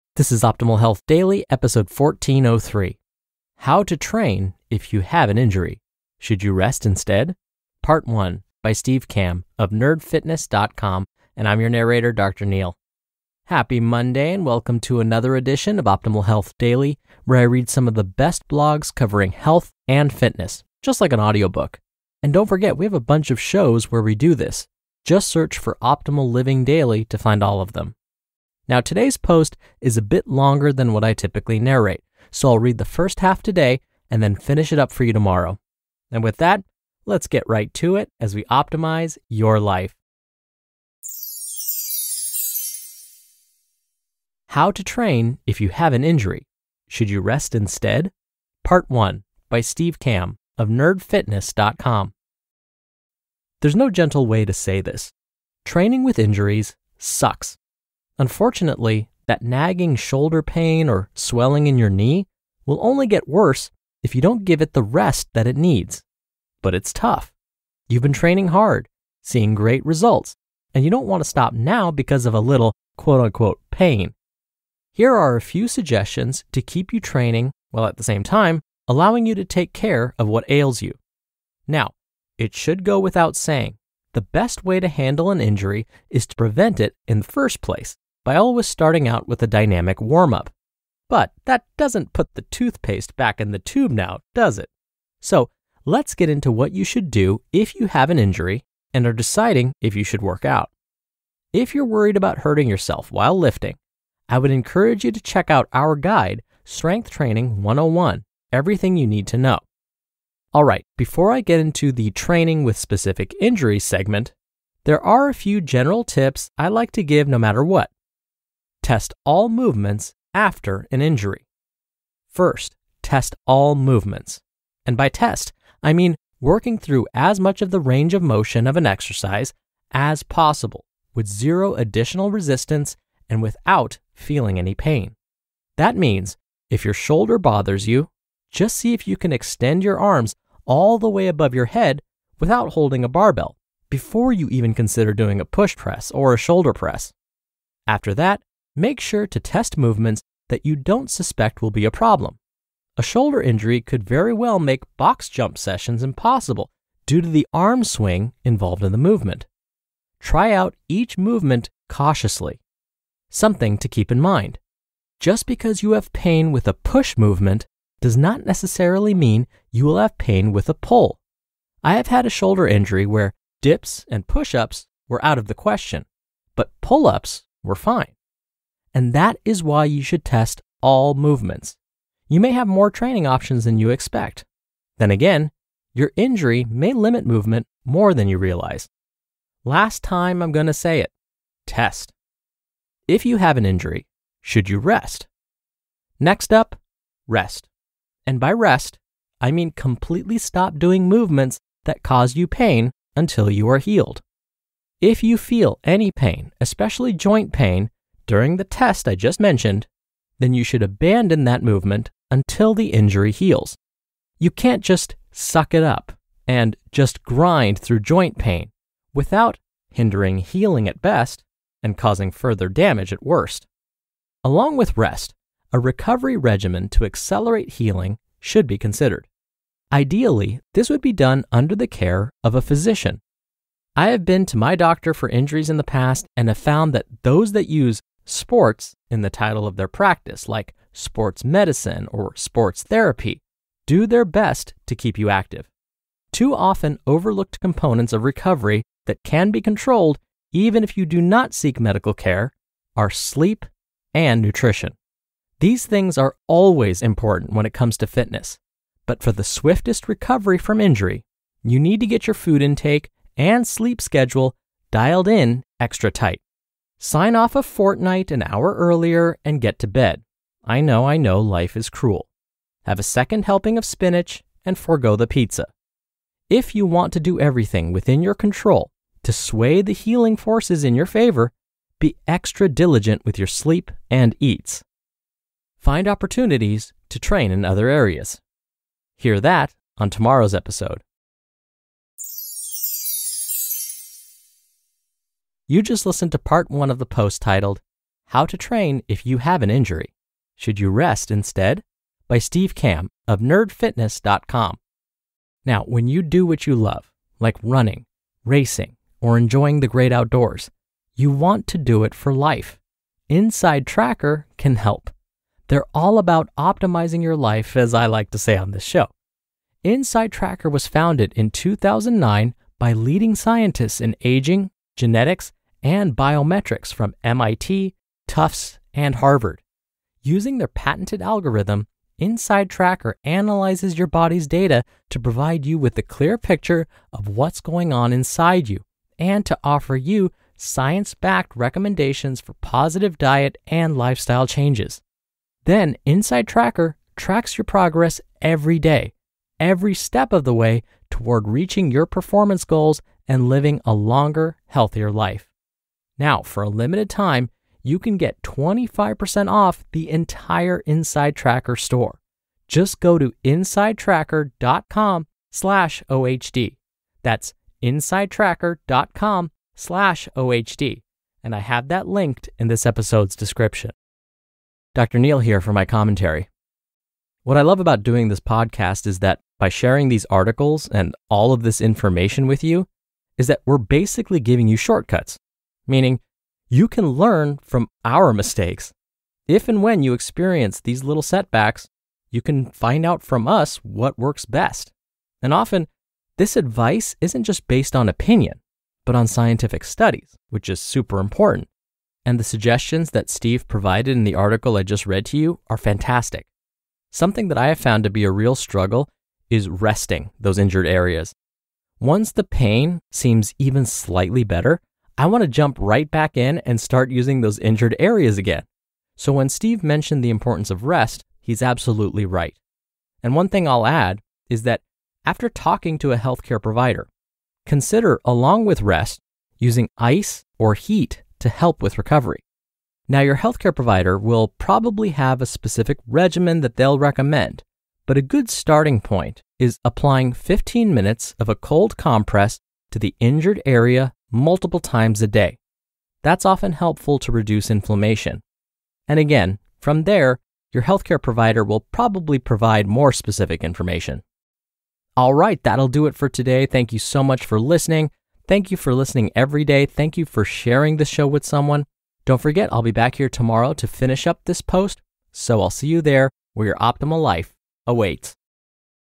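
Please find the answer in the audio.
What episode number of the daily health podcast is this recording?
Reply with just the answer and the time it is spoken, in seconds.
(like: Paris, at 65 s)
1403, at 1 s.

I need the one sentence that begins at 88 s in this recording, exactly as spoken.
By always starting out with a dynamic warm up.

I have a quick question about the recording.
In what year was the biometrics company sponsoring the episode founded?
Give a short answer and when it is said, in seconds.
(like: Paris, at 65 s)
2009, at 321 s.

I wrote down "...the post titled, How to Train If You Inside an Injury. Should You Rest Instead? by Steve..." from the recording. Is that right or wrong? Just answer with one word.
wrong.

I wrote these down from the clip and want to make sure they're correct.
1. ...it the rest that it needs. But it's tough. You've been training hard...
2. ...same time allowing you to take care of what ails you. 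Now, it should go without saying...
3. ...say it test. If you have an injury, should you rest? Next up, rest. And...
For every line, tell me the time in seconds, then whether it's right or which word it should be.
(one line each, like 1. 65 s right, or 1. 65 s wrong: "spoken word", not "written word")
1. 64 s right
2. 78 s right
3. 190 s right.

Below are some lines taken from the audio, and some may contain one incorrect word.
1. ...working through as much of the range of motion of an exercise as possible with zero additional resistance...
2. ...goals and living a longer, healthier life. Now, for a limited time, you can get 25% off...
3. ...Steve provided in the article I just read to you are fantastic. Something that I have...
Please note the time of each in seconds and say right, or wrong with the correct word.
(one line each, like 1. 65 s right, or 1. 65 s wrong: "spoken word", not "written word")
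1. 126 s right
2. 352 s right
3. 403 s right.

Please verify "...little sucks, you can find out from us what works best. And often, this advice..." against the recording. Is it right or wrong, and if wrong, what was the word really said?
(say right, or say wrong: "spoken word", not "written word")
wrong: "setbacks", not "sucks".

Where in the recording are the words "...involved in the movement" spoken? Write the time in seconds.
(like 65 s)
158 s.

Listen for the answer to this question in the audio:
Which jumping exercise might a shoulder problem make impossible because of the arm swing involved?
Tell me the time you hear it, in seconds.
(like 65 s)
154 s.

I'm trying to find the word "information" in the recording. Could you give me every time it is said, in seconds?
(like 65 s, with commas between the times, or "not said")
381 s, 453 s.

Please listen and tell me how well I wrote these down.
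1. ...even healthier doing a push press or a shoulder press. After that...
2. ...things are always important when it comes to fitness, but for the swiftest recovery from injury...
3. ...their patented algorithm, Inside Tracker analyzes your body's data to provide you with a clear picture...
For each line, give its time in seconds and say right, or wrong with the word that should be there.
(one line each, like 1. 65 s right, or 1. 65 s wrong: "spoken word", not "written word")
1. 144 s wrong: "consider", not "healthier"
2. 255 s right
3. 330 s right.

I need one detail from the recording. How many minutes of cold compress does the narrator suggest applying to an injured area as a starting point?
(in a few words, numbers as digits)
15.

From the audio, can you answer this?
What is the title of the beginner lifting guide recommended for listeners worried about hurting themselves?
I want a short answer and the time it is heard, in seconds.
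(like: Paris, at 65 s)
Strength Training 101, at 106 s.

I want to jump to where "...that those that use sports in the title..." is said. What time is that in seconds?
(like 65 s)
236 s.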